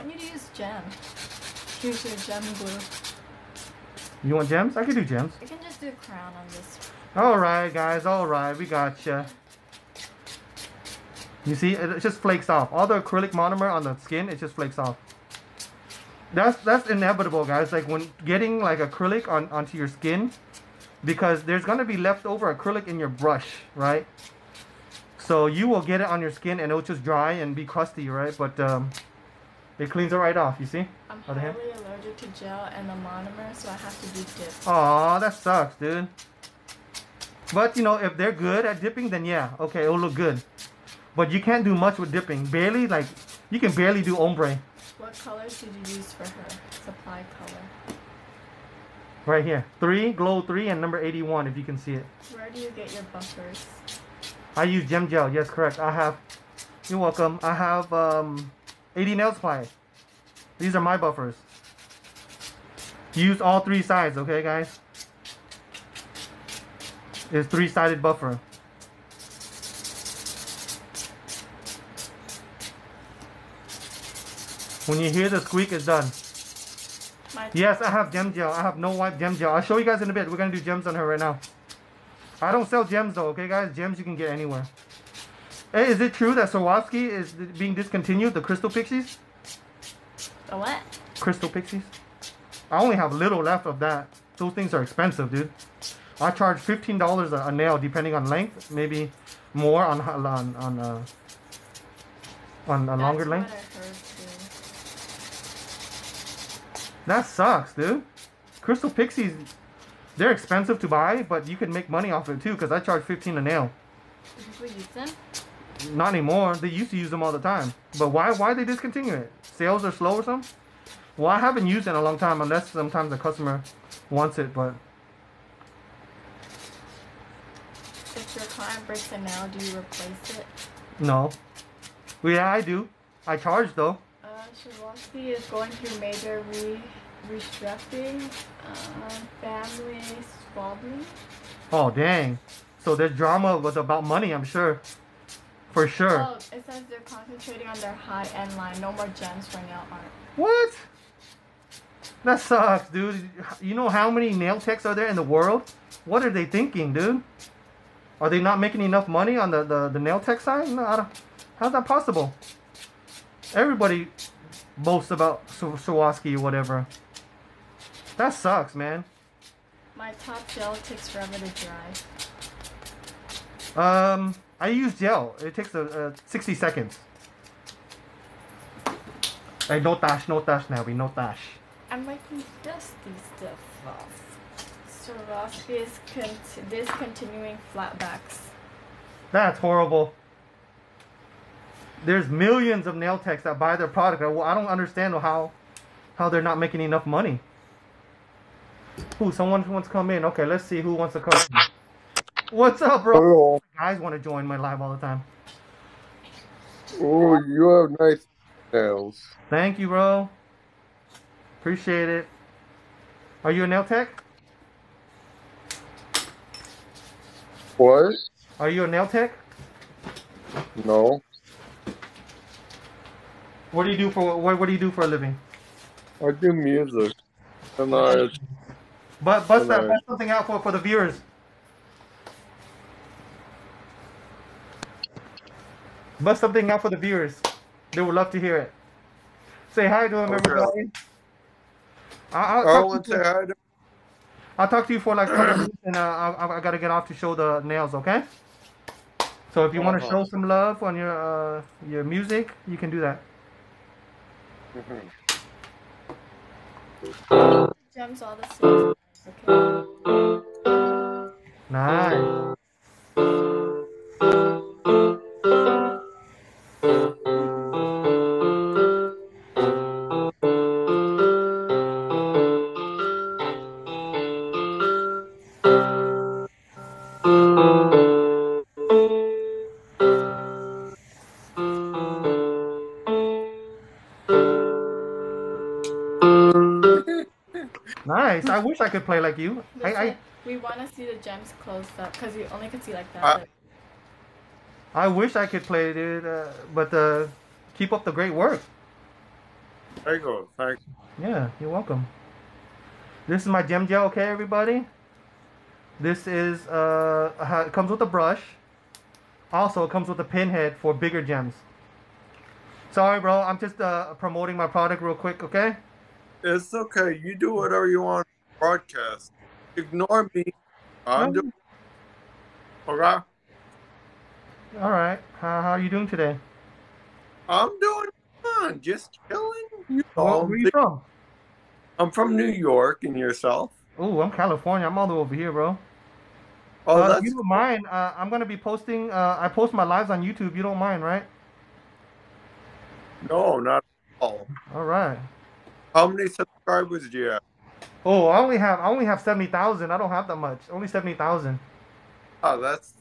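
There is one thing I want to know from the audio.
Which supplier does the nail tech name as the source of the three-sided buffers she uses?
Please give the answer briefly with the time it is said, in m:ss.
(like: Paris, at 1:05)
AD Nail Supply, at 0:58.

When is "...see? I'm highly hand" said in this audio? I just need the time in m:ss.
0:30.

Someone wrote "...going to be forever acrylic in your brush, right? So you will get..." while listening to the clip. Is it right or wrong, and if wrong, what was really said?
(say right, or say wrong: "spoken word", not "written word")
wrong: "leftover", not "forever".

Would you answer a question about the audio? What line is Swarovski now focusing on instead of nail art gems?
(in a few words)
high-end line.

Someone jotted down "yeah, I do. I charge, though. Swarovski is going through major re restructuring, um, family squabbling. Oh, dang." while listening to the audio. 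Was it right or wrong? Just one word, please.
right.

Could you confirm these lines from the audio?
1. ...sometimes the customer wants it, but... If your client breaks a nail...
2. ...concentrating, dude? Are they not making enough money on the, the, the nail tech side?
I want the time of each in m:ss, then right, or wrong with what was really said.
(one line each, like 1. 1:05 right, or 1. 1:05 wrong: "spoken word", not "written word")
1. 2:02 right
2. 2:36 wrong: "thinking", not "concentrating".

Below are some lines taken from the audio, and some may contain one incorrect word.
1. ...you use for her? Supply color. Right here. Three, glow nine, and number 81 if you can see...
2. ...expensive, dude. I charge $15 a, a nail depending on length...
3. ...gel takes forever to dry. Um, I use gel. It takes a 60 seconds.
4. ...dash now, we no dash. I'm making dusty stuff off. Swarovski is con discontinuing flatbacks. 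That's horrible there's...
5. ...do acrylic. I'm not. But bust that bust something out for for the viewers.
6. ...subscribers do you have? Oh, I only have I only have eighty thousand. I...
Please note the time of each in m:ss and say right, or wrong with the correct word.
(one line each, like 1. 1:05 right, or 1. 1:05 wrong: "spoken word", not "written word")
1. 0:45 wrong: "three", not "nine"
2. 1:34 right
3. 2:50 right
4. 3:00 right
5. 3:46 wrong: "music", not "acrylic"
6. 5:46 wrong: "seventy", not "eighty".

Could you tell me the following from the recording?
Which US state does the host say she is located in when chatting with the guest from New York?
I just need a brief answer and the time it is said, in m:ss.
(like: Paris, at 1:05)
California, at 5:34.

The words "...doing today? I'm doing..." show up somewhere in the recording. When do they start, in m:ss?
5:25.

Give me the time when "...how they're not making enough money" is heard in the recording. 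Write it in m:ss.
3:16.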